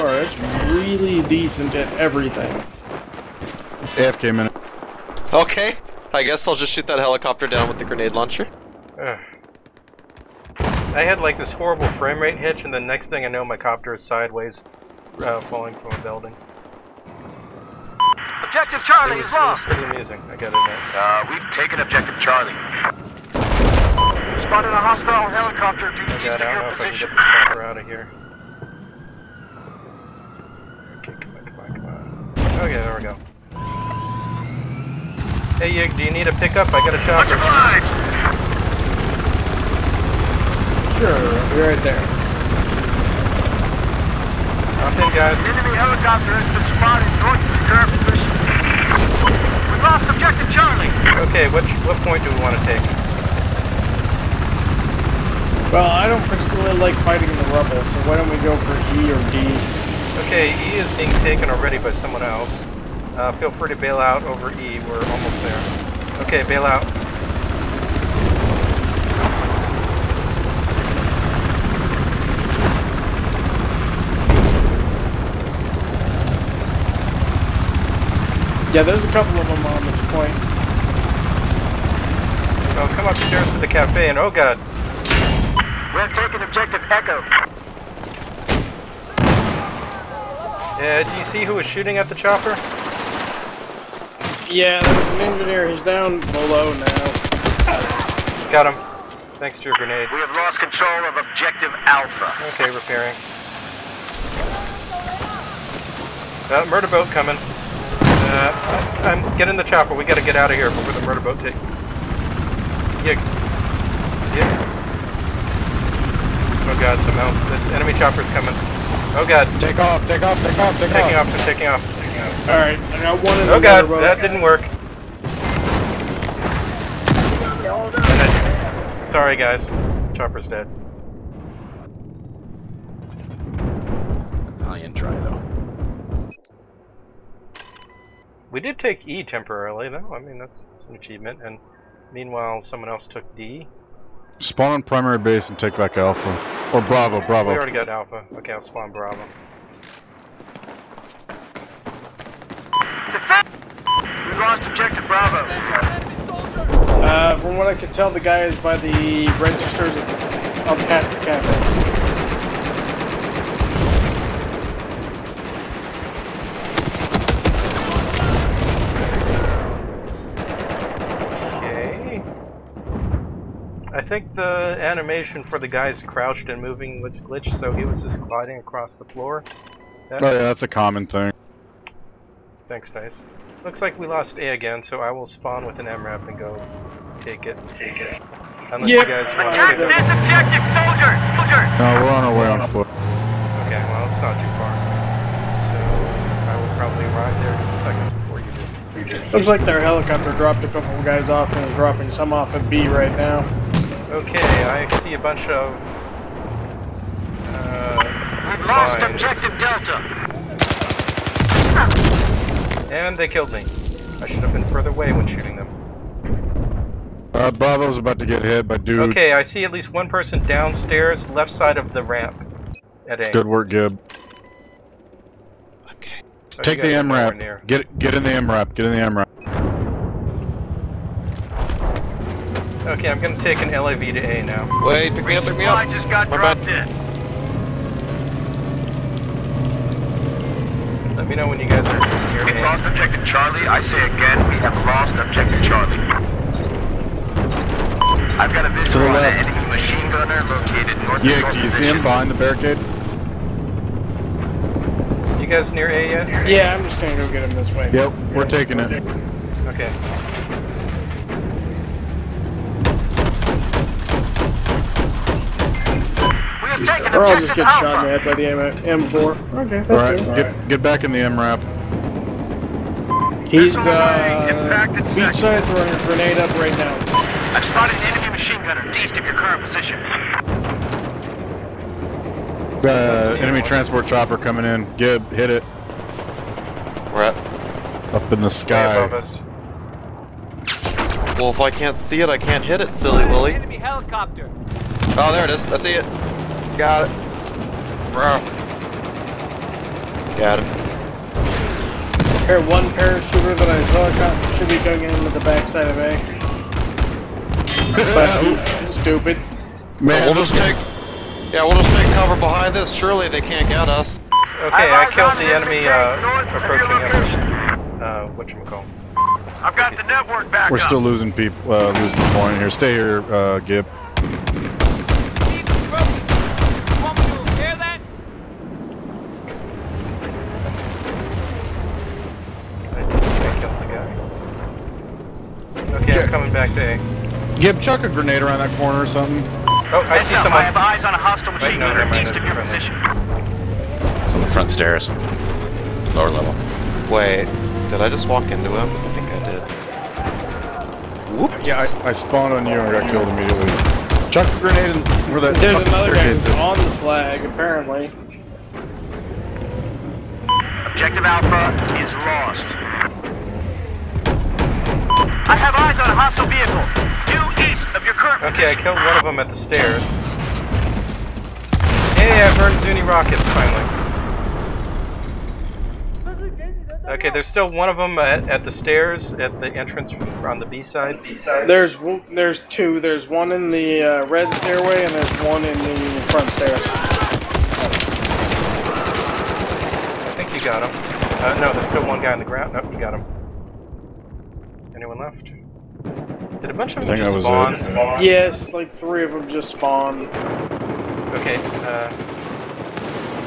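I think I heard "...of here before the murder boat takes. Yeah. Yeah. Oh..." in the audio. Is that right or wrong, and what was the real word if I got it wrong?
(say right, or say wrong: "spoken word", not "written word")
right.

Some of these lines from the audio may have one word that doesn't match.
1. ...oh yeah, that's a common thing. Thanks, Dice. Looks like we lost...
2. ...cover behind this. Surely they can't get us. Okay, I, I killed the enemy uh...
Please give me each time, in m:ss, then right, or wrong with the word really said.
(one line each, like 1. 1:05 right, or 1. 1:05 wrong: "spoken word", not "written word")
1. 3:00 right
2. 5:12 right.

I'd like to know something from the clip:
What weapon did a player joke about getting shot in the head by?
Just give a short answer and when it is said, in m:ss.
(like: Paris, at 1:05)
M4, at 4:28.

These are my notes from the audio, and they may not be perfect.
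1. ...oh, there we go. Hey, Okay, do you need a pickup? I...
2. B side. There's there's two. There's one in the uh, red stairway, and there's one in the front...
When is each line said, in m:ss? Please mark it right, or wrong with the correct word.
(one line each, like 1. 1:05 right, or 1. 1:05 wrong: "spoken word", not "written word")
1. 0:32 wrong: "Yig", not "Okay"
2. 6:21 right.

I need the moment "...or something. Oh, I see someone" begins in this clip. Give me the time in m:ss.
5:39.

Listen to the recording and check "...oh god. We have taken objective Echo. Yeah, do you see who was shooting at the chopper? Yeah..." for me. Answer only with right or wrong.
right.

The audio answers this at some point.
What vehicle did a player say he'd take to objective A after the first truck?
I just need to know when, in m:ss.
3:53.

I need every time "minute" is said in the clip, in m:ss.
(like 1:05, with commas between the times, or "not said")
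0:04.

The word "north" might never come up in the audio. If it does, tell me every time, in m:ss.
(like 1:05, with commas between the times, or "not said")
0:47, 4:11.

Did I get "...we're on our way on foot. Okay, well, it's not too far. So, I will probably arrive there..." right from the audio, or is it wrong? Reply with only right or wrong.
right.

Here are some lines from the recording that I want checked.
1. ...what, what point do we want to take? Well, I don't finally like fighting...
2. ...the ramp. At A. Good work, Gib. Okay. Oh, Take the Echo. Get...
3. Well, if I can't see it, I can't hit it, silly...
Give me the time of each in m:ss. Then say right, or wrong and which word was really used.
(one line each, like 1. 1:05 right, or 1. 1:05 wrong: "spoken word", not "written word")
1. 0:51 wrong: "particularly", not "finally"
2. 3:41 wrong: "MRAP", not "Echo"
3. 4:51 right.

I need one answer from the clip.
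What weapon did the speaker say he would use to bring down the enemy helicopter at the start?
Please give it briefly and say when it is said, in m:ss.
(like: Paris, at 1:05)
Grenade launcher, at 0:07.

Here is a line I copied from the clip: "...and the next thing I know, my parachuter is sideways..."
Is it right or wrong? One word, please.
wrong.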